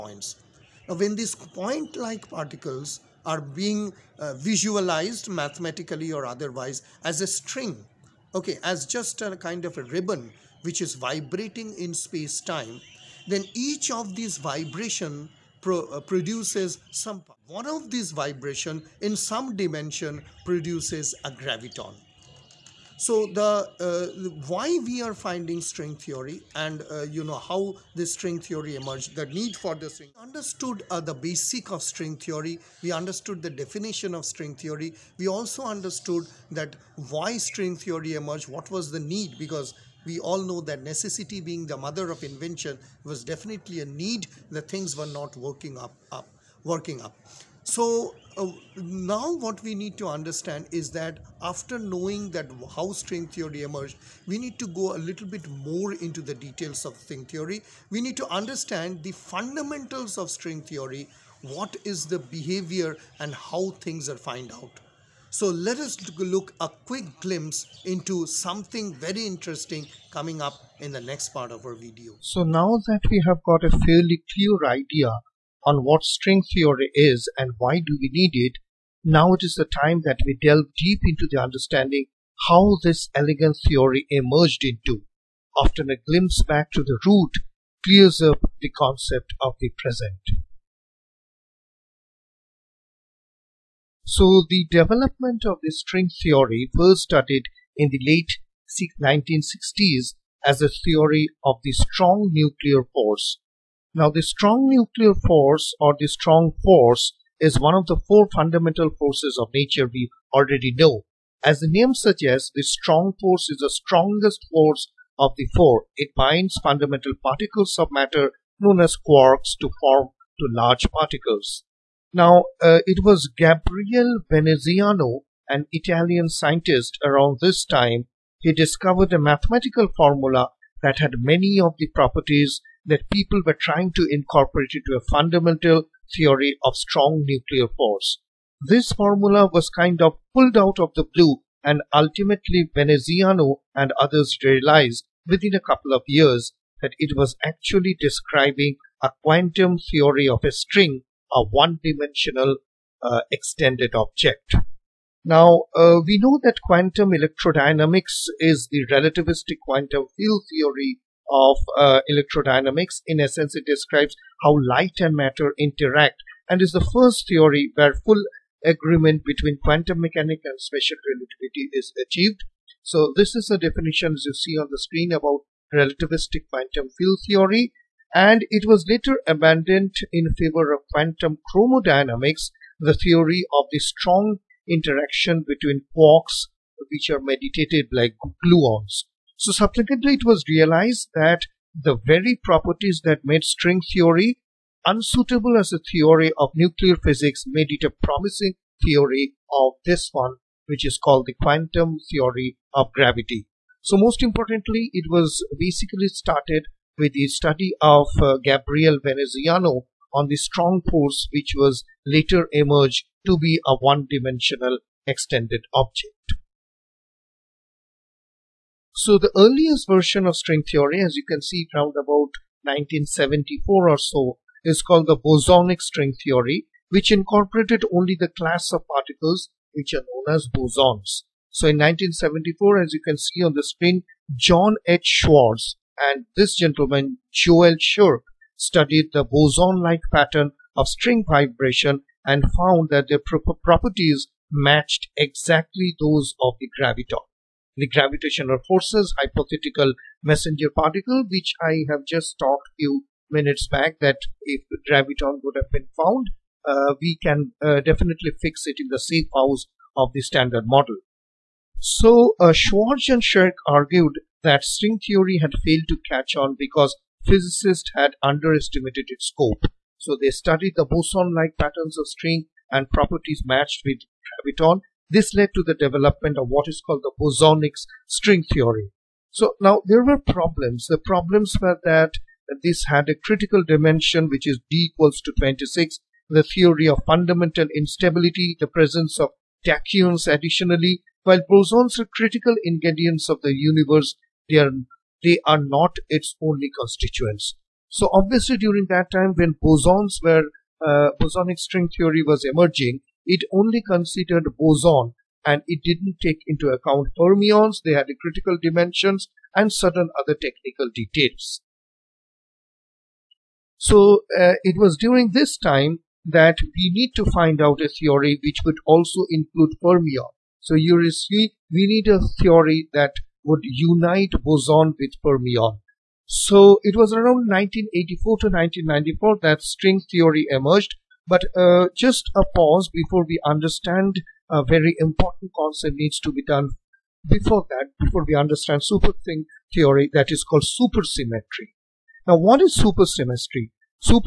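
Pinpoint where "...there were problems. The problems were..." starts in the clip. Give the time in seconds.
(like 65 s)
279 s.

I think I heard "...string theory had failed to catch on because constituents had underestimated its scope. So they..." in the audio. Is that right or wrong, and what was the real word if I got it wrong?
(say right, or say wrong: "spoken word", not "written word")
wrong: "physicists", not "constituents".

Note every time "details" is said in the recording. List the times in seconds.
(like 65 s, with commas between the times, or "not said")
56 s, 310 s.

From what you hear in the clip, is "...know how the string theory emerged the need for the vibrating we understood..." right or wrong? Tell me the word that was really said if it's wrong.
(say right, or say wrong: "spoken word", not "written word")
wrong: "string", not "vibrating".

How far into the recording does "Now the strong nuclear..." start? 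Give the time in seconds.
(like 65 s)
103 s.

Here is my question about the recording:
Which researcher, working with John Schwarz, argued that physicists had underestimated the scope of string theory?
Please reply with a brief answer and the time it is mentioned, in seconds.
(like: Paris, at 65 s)
Joel Scherk, at 237 s.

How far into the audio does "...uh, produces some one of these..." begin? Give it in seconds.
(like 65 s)
15 s.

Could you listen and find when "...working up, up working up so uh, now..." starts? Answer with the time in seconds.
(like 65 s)
45 s.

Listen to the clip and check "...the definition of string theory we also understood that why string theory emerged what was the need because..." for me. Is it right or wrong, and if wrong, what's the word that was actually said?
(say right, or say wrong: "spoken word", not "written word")
right.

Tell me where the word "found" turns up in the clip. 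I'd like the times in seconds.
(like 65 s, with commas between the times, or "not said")
64 s, 242 s, 255 s.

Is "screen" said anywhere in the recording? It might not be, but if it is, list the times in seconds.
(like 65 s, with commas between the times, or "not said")
174 s, 233 s.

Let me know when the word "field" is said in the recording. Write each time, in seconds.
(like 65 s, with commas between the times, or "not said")
160 s, 176 s.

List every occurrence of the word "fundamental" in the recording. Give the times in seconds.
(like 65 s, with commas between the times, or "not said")
59 s, 108 s, 116 s, 135 s, 287 s.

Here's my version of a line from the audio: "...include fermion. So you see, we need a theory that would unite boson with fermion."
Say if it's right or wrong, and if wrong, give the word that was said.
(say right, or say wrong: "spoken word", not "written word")
right.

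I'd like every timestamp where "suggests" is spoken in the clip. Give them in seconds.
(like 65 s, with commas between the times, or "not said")
111 s.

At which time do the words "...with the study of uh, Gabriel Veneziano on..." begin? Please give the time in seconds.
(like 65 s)
206 s.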